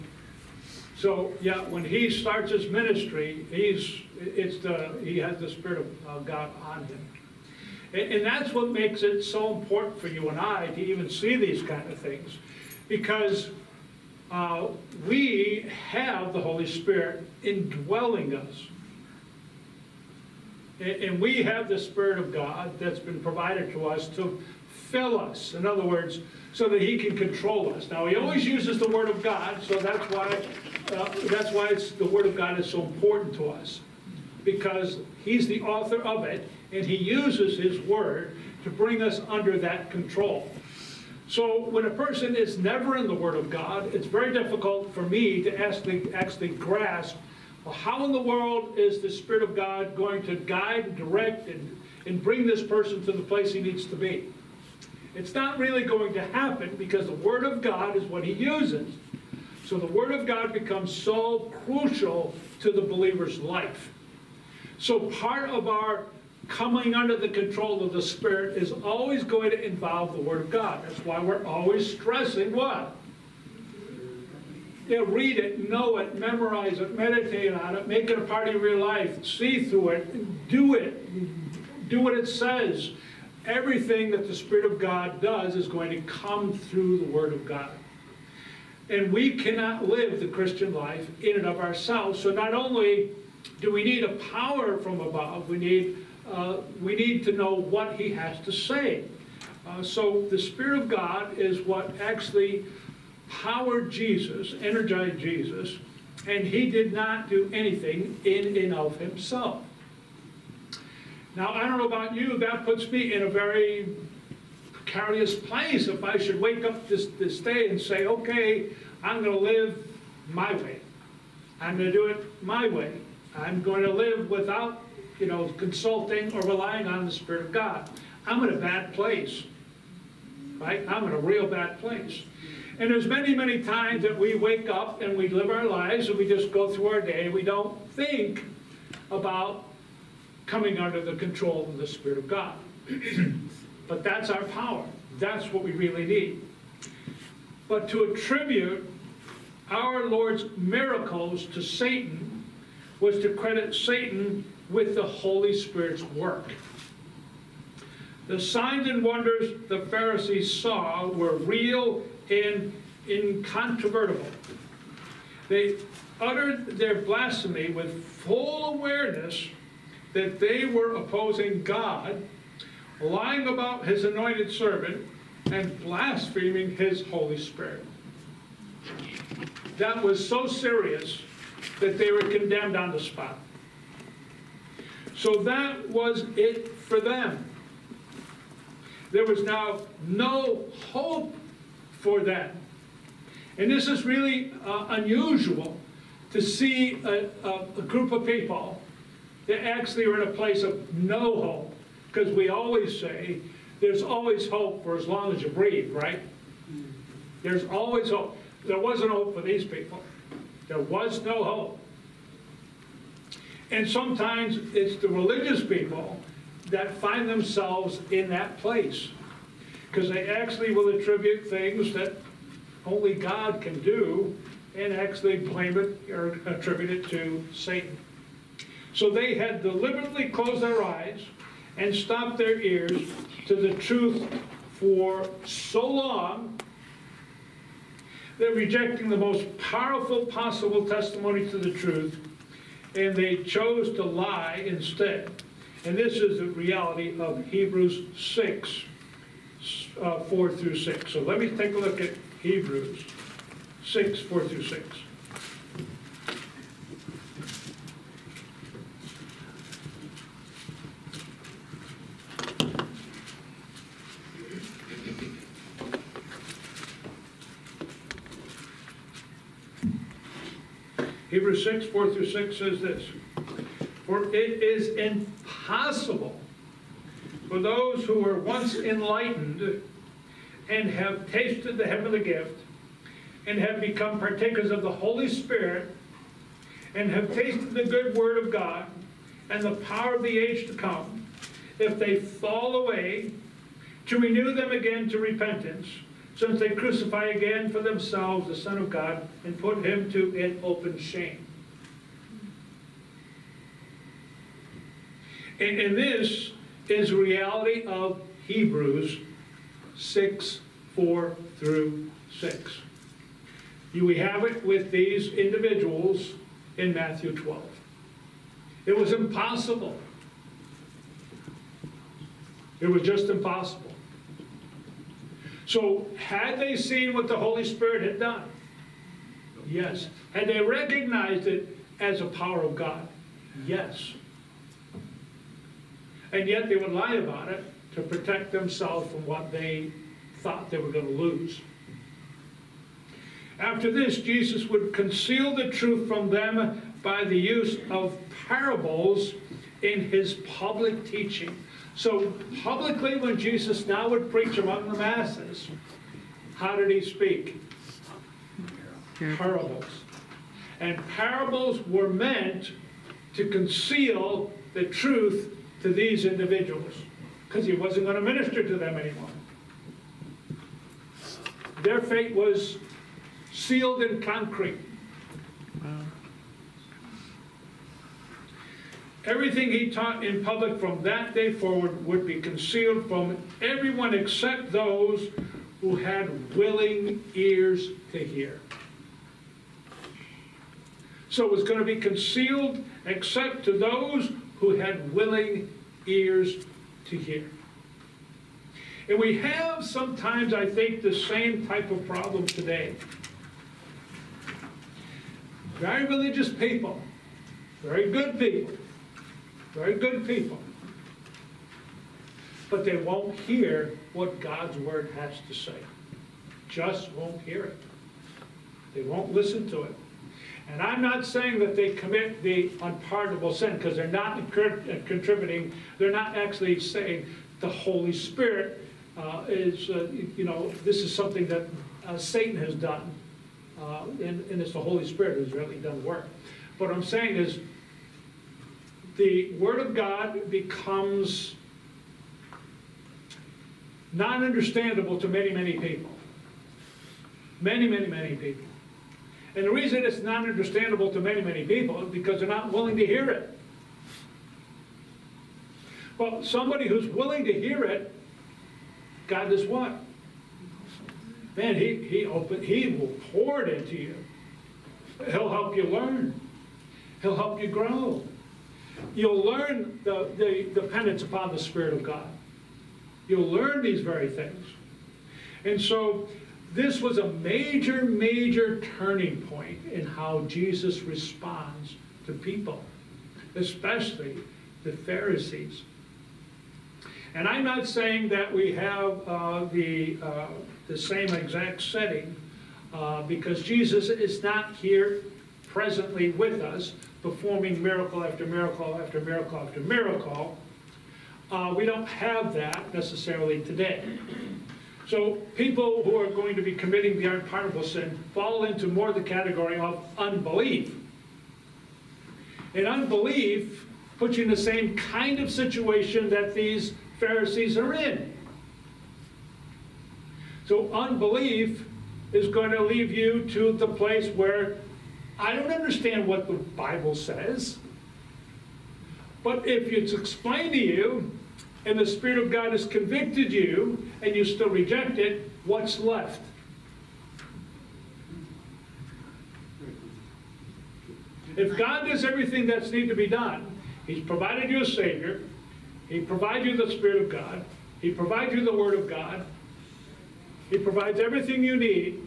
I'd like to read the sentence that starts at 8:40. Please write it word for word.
So unbelief is going to leave you to the place where I don't understand what the Bible says.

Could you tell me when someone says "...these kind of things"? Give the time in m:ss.
0:11.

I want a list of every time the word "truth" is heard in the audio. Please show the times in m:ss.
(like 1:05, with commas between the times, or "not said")
3:53, 4:01, 5:45, 6:04.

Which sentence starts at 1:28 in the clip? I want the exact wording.
And we cannot live the Christian life in and of ourselves.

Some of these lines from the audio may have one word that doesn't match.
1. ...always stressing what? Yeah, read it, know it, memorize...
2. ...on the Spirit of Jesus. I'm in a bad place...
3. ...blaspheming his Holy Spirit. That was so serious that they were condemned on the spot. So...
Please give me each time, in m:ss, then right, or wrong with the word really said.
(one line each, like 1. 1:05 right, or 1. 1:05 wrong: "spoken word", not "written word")
1. 1:11 right
2. 2:06 wrong: "God", not "Jesus"
3. 2:55 right.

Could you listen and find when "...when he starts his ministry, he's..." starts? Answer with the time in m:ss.
0:01.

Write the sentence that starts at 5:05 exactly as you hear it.
And, and this is reality of Hebrews 6, 4 through 6.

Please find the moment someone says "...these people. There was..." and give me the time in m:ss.
3:29.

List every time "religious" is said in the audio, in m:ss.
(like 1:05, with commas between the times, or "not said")
3:35, 6:46.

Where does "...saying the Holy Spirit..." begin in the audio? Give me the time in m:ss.
7:06.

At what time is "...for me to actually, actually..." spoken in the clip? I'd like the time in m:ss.
0:44.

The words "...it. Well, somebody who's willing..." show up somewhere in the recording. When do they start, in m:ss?
7:33.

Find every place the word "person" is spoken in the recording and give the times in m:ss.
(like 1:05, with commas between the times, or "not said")
0:41, 0:52.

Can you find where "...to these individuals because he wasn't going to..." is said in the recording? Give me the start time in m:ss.
6:05.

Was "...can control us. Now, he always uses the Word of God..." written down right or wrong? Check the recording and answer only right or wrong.
right.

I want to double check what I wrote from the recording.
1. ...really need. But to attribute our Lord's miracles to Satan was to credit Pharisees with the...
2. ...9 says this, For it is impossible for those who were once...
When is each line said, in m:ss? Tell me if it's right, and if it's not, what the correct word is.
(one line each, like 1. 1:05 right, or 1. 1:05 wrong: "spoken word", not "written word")
1. 2:25 wrong: "Satan", not "Pharisees"
2. 4:32 wrong: "6", not "9".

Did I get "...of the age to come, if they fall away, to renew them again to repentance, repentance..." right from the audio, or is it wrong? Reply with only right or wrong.
wrong.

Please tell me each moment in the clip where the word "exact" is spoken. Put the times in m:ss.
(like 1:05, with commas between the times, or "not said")
8:11.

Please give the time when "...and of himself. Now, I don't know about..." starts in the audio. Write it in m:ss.
1:48.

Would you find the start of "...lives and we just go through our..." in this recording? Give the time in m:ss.
2:15.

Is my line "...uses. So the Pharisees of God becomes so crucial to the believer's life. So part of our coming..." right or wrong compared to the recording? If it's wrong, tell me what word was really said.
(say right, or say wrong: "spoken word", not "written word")
wrong: "Word", not "Pharisees".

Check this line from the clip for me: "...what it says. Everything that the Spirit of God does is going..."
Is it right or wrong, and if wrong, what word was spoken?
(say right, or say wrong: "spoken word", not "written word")
right.